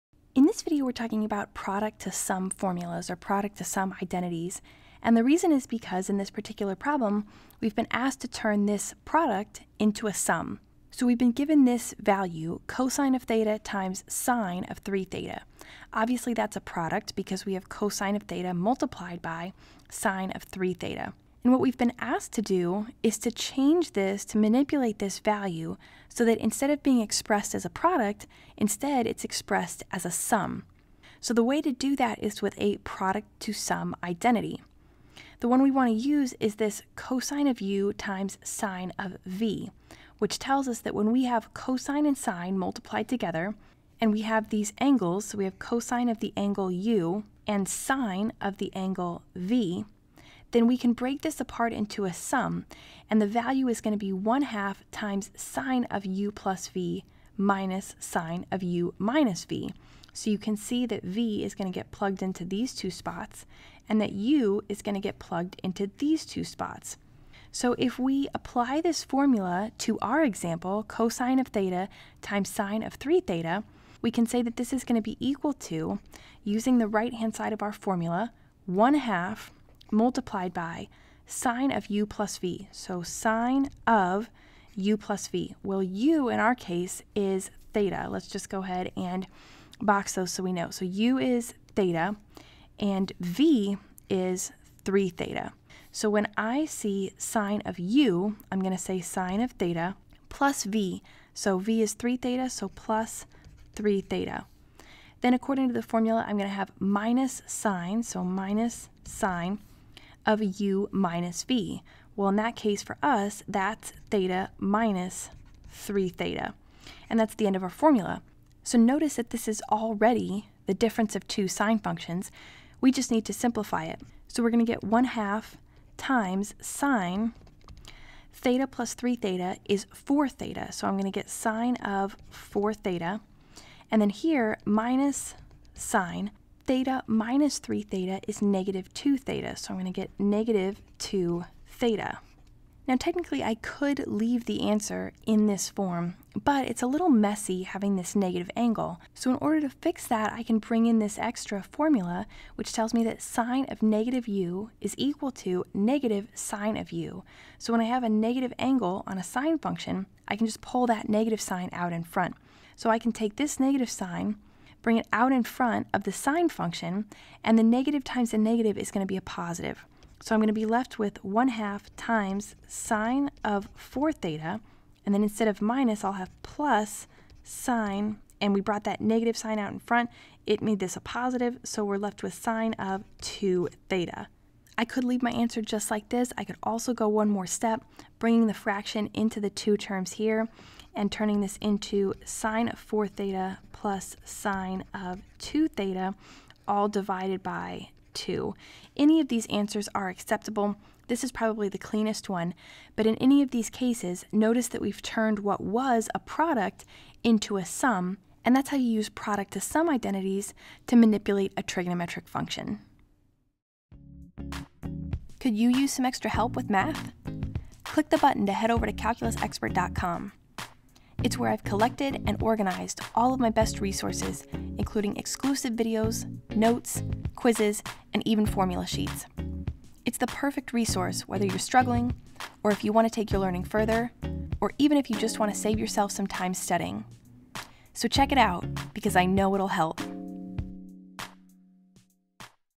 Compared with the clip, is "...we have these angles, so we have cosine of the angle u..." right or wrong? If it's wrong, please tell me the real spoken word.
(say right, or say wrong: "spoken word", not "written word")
right.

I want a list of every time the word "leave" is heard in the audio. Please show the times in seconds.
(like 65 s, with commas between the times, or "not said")
144 s, 185 s.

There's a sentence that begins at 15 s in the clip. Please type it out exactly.
Obviously, that's a product because we have cosine of theta multiplied by sine of 3 theta.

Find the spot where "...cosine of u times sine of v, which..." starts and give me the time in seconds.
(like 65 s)
36 s.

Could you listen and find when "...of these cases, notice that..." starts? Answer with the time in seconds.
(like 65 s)
203 s.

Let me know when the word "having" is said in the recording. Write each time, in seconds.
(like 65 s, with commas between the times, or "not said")
147 s.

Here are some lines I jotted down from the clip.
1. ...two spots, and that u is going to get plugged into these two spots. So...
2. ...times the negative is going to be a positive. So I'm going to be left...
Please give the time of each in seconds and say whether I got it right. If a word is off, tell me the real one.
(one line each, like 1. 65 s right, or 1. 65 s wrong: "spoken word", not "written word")
1. 62 s right
2. 168 s right.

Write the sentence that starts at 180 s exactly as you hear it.
It made this a positive, so we're left with sine of 2 theta.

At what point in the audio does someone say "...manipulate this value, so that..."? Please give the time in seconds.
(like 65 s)
24 s.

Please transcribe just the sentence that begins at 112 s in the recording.
Well, in that case for us, that's theta minus 3 theta.